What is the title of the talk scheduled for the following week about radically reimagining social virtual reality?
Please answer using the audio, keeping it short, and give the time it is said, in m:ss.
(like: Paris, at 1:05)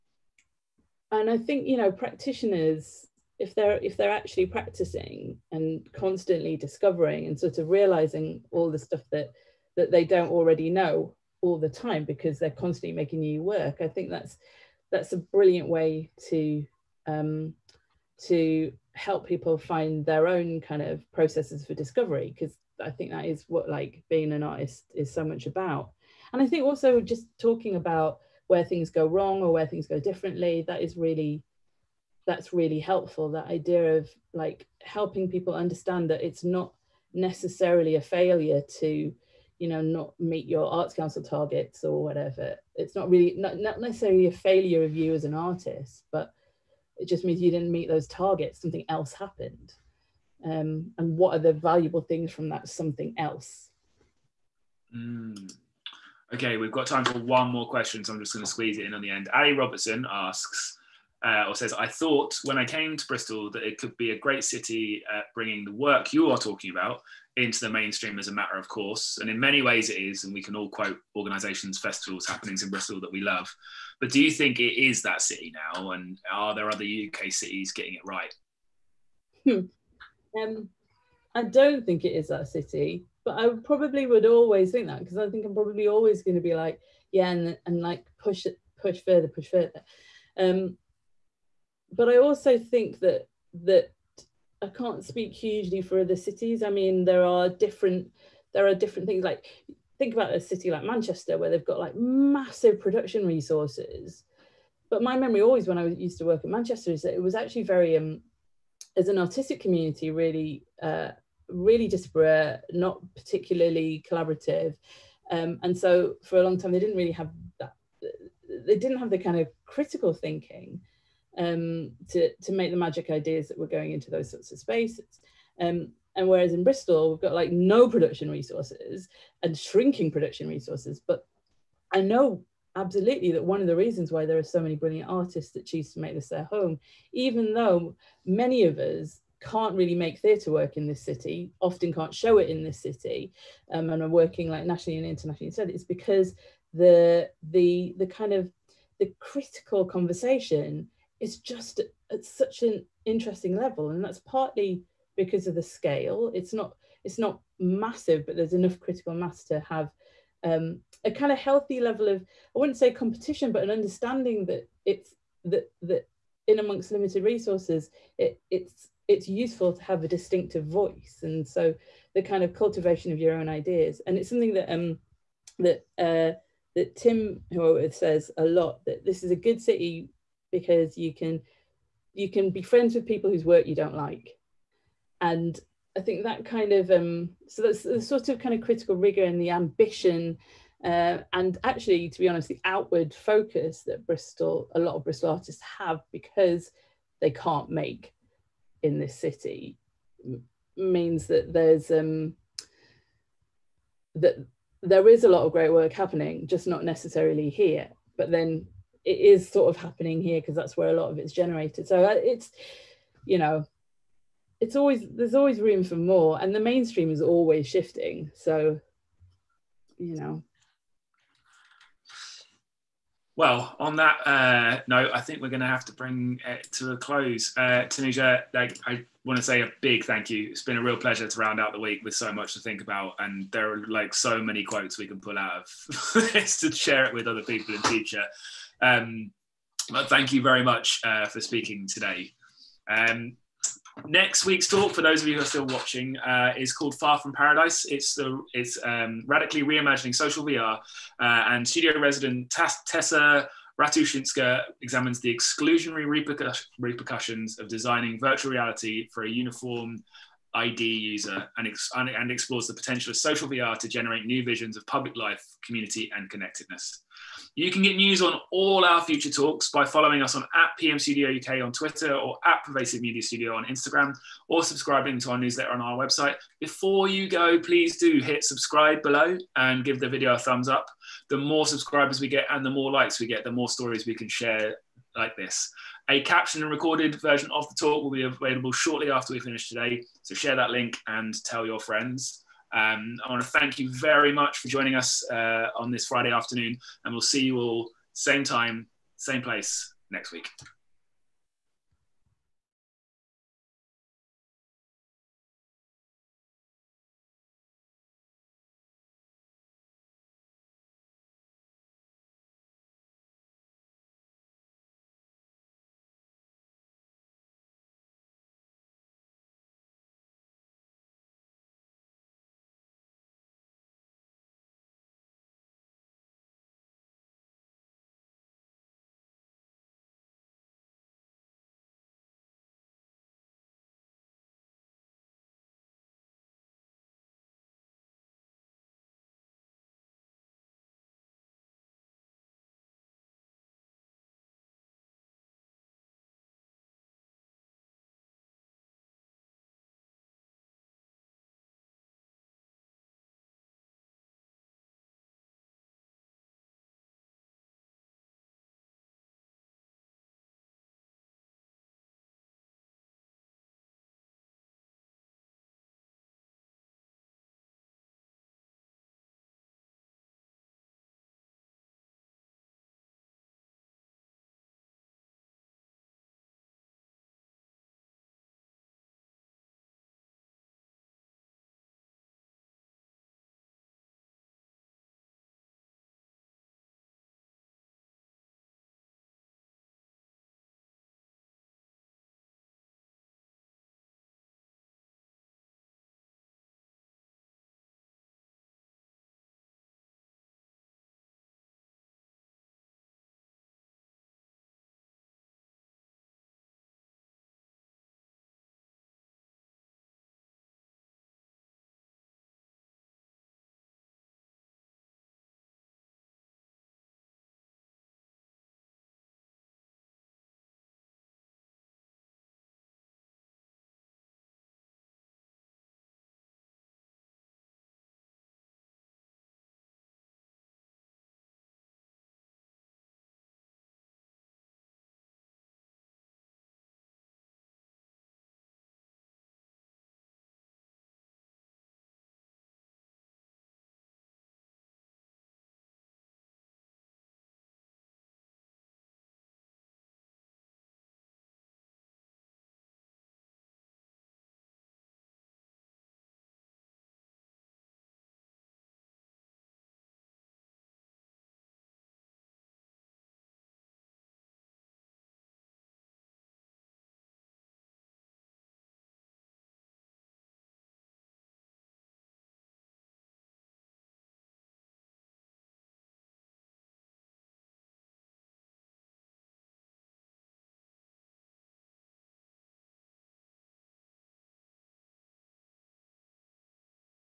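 Far From Paradise, at 4:06.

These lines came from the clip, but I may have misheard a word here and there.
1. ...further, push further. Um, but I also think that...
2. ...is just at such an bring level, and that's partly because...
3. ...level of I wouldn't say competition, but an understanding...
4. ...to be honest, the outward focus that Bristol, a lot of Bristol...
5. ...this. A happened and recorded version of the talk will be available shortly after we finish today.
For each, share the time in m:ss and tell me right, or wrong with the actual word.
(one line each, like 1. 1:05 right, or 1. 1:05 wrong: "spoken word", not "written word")
1. 1:29 right
2. 2:31 wrong: "interesting", not "bring"
3. 2:41 right
4. 3:12 right
5. 4:45 wrong: "captioned", not "happened".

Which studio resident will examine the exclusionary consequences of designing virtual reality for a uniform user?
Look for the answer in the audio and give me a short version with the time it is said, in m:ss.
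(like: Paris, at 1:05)
Tessa Ratuszynska, at 4:12.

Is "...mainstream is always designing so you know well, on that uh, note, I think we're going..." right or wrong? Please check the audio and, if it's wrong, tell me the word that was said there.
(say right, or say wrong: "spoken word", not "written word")
wrong: "shifting", not "designing".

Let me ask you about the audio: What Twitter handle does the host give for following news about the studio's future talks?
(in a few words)
PM Studio UK.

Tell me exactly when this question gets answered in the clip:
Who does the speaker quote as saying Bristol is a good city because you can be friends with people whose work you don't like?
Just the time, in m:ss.
2:56.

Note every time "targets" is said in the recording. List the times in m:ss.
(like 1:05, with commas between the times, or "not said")
0:41, 0:48.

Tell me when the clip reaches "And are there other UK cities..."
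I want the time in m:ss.
1:15.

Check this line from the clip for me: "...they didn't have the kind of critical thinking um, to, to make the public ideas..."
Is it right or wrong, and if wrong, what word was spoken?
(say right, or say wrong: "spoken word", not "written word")
wrong: "magic", not "public".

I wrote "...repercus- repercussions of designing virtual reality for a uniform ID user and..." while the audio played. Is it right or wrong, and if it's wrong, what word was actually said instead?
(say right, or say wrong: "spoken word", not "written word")
right.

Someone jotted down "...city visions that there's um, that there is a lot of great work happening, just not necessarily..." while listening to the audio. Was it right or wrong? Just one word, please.
wrong.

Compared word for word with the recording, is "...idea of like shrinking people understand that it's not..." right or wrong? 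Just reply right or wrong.
wrong.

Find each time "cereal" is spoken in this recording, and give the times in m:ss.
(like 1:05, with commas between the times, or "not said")
not said.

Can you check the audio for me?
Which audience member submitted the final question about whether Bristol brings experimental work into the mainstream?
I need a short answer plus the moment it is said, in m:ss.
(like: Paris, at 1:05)
Ali Robertson, at 0:59.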